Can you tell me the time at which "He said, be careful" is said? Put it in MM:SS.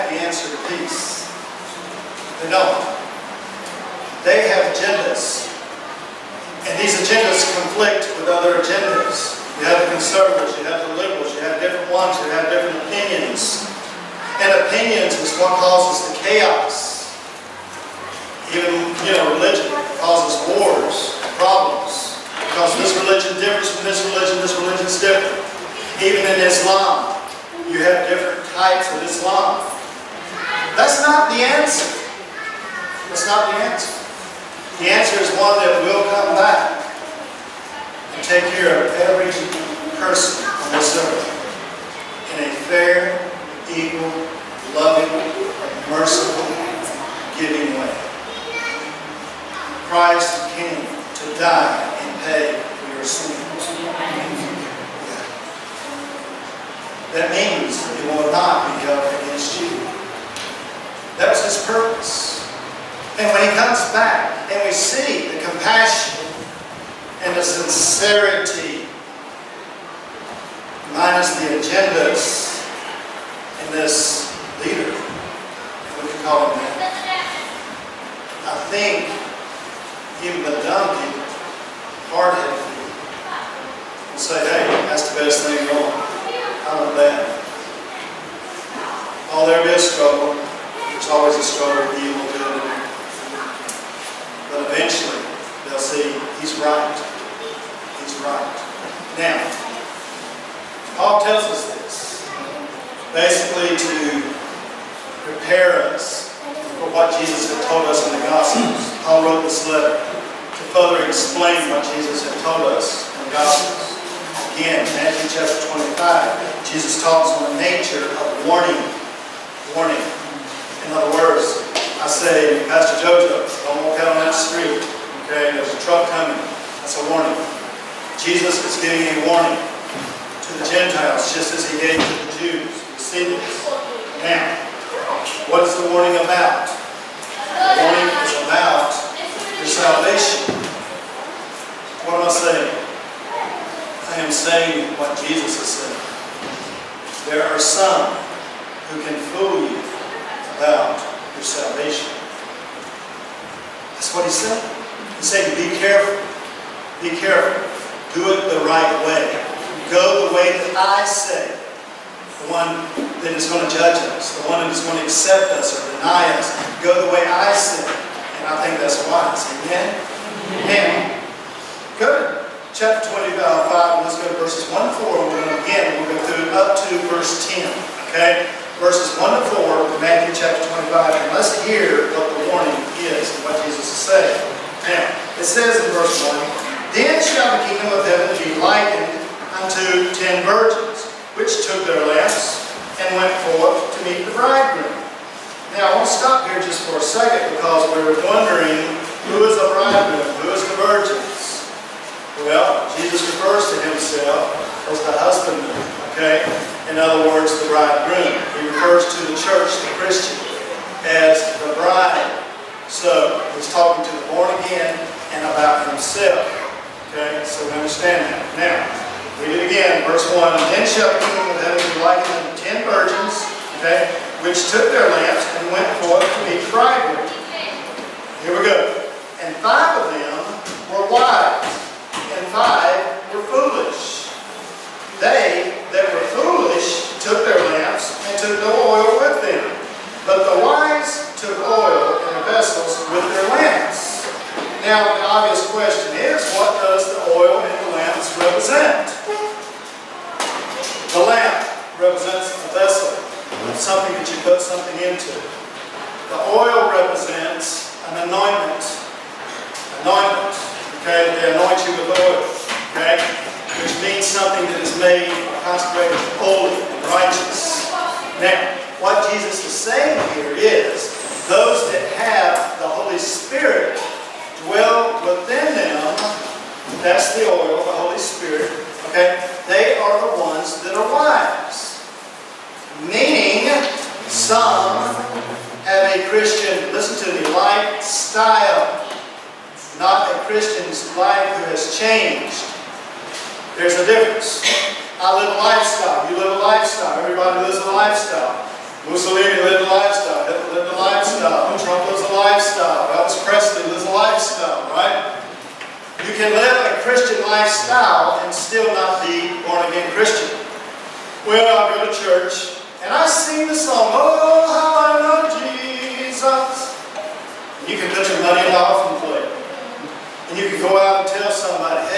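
02:35.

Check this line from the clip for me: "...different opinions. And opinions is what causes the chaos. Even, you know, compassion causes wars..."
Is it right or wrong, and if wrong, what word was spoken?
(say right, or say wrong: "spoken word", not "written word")
wrong: "religion", not "compassion".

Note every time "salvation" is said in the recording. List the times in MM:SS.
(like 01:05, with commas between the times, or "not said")
02:19, 02:31.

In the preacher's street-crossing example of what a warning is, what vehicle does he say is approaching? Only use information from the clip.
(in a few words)
A truck.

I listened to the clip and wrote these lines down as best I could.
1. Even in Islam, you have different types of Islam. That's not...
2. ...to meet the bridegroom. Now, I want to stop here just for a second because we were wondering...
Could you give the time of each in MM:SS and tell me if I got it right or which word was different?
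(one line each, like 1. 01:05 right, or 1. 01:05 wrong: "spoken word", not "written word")
1. 00:26 right
2. 03:13 right.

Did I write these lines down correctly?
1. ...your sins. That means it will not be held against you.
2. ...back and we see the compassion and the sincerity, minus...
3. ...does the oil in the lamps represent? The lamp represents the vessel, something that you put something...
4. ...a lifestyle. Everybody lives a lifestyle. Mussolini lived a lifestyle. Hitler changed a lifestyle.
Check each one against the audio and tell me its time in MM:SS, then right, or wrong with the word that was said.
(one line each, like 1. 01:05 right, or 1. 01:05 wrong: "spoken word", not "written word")
1. 00:52 right
2. 01:03 right
3. 04:06 right
4. 04:56 wrong: "lived", not "changed".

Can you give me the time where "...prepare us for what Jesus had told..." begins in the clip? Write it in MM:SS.
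01:45.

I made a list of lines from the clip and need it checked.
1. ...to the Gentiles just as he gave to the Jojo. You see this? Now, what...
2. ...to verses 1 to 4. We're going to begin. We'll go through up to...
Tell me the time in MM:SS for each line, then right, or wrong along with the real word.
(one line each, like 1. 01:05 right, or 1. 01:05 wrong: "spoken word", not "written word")
1. 02:09 wrong: "Jews", not "Jojo"
2. 02:54 right.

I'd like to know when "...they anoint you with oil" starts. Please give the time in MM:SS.
04:21.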